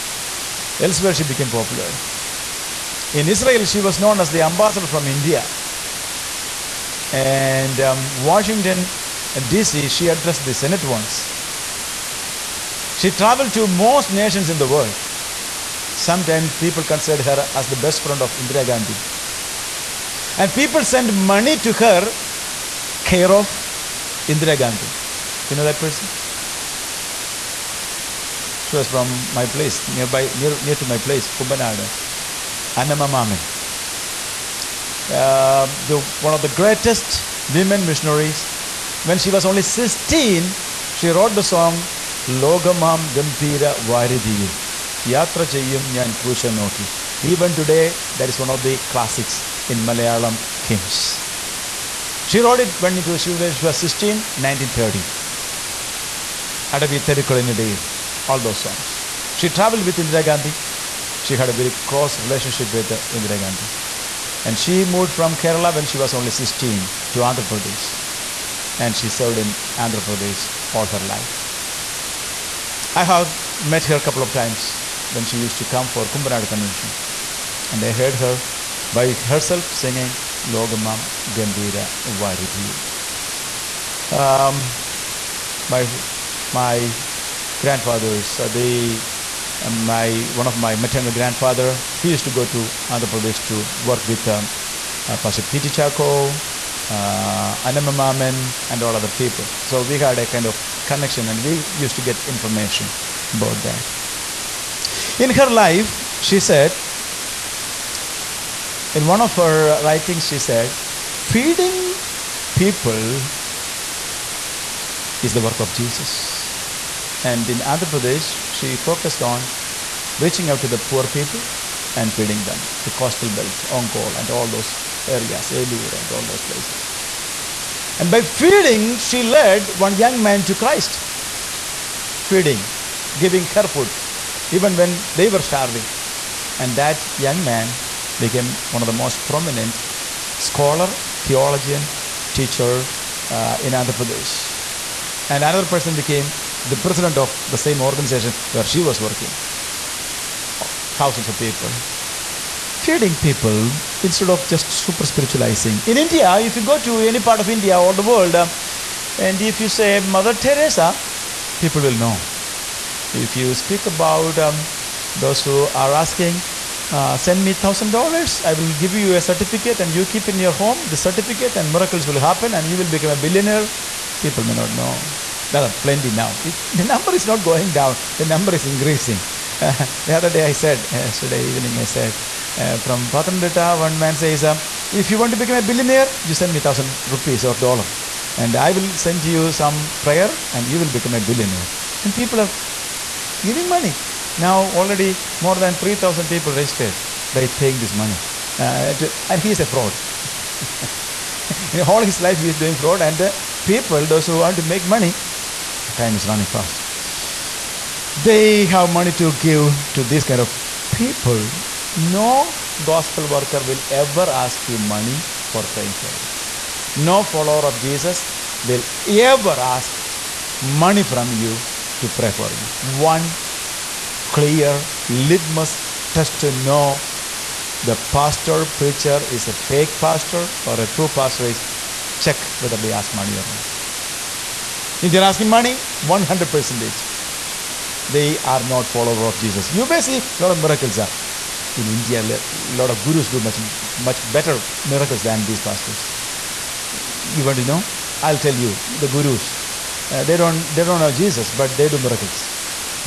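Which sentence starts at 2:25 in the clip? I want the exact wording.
And another person became the president of the same organization where she was working.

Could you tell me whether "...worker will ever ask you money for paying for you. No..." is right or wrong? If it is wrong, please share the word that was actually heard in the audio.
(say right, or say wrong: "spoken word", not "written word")
wrong: "praying", not "paying".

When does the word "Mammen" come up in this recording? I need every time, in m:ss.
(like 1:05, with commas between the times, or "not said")
0:33, 1:37.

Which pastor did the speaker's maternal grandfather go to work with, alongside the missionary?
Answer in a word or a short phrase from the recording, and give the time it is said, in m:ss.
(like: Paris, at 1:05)
P.T. Chacko, at 1:35.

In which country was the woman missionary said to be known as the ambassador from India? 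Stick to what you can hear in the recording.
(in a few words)
Israel.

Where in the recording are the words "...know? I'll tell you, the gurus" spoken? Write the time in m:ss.
4:07.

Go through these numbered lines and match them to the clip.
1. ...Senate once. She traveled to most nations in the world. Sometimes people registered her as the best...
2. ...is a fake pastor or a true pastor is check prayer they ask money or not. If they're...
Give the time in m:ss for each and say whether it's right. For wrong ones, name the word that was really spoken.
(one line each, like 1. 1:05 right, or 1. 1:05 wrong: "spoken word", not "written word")
1. 0:10 wrong: "considered", not "registered"
2. 3:49 wrong: "whether", not "prayer".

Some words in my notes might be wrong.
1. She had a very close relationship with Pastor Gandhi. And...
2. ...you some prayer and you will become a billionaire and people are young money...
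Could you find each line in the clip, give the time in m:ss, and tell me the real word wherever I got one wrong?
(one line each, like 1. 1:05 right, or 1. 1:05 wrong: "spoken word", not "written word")
1. 1:01 wrong: "Indira", not "Pastor"
2. 3:09 wrong: "giving", not "young".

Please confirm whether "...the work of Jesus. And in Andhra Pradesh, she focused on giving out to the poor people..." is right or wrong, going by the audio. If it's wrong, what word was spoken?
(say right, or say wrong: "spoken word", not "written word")
wrong: "reaching", not "giving".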